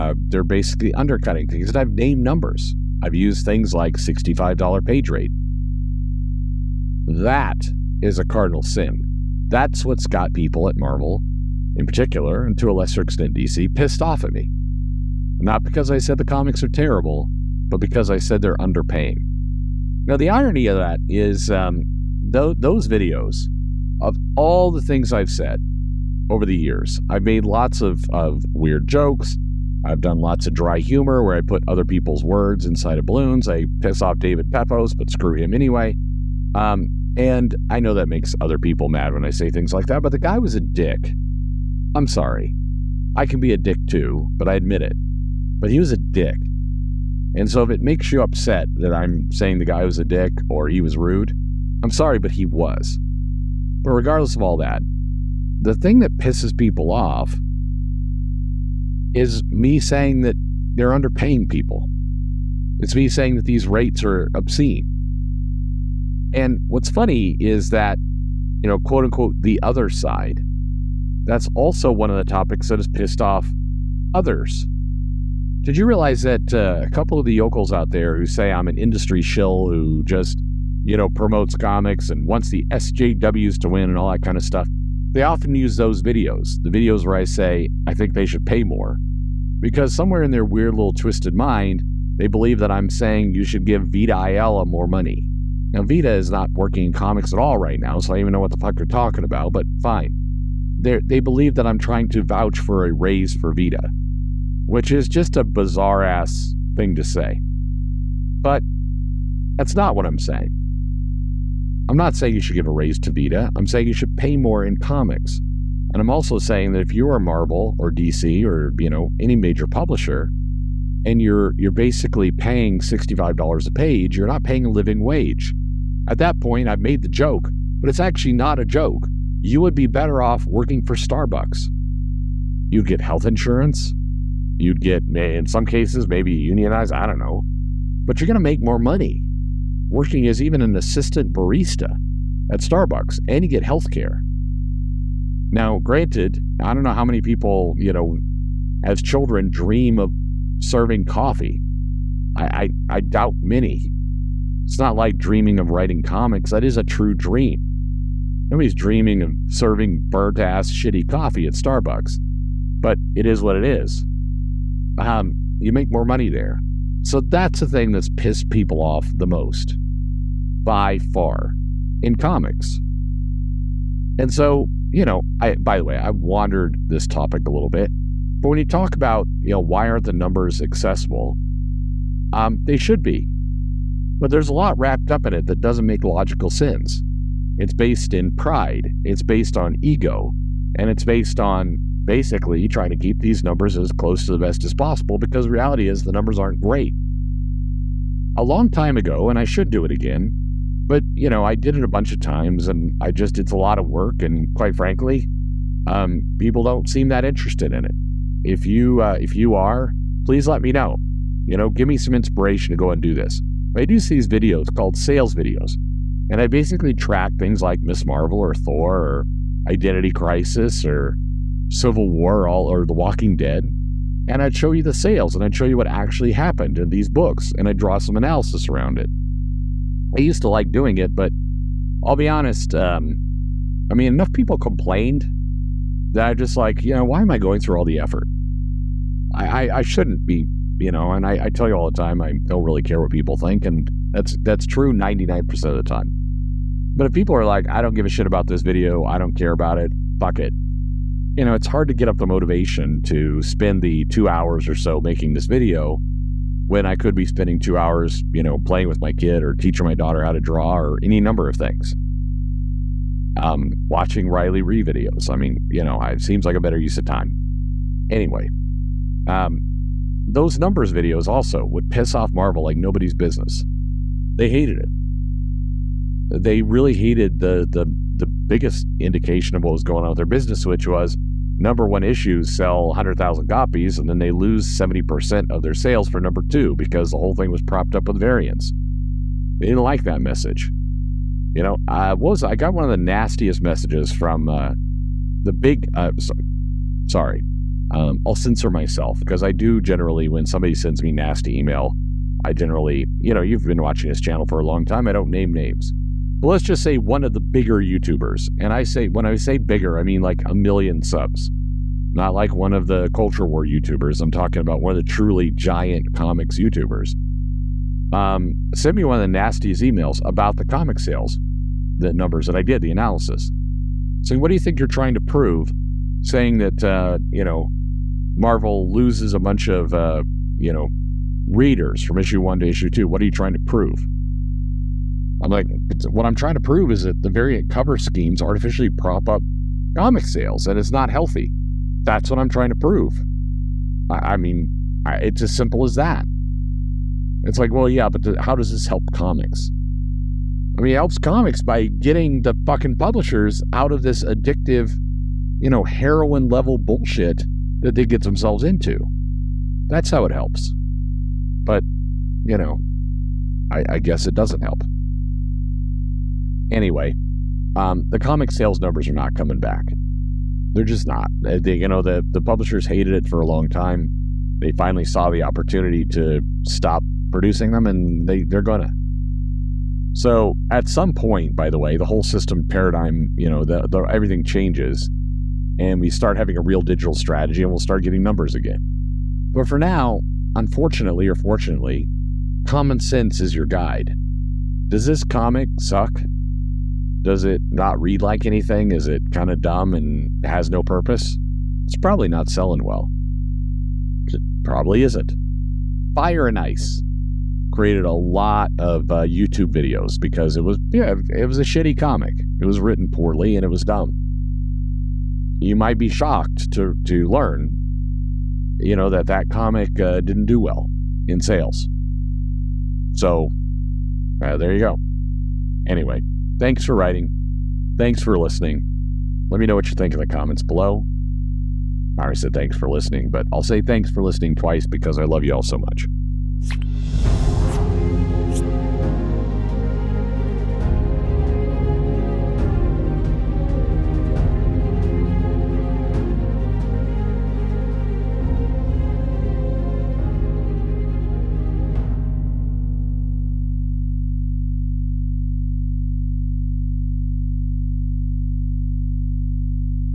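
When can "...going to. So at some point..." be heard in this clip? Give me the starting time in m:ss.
6:18.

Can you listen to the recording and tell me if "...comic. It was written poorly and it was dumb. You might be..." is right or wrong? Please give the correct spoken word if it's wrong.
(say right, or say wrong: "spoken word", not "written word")
right.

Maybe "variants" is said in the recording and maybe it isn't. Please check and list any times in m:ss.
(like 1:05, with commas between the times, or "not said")
4:48, 5:37.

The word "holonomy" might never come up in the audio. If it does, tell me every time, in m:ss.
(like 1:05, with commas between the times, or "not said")
not said.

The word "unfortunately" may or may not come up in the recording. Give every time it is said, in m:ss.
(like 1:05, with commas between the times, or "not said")
6:30.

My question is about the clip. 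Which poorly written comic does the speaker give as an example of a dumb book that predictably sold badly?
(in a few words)
Fire and Ice.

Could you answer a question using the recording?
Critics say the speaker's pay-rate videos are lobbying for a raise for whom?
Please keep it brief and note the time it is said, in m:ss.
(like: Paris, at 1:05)
Vita Ayala, at 1:33.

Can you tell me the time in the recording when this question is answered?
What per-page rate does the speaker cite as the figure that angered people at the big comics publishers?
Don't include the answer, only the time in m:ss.
0:03.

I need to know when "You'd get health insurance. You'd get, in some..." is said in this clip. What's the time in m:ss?
2:12.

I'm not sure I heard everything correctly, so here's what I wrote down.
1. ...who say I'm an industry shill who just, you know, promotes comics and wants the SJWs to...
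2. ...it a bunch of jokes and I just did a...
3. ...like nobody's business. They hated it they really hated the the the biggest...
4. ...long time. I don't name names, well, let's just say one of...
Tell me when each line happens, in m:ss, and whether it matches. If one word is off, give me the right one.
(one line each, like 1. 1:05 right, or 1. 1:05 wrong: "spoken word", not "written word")
1. 1:18 right
2. 3:21 wrong: "times", not "jokes"
3. 4:32 right
4. 5:04 right.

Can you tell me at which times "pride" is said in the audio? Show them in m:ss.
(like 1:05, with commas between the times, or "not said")
3:08.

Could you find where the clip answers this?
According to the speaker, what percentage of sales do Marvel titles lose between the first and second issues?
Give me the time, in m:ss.
4:44.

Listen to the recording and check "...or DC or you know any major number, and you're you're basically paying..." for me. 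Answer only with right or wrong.
wrong.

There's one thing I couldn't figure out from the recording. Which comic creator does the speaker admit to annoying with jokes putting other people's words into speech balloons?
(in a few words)
David Pepose.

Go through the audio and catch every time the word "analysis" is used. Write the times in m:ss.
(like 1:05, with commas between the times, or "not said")
3:48, 5:22.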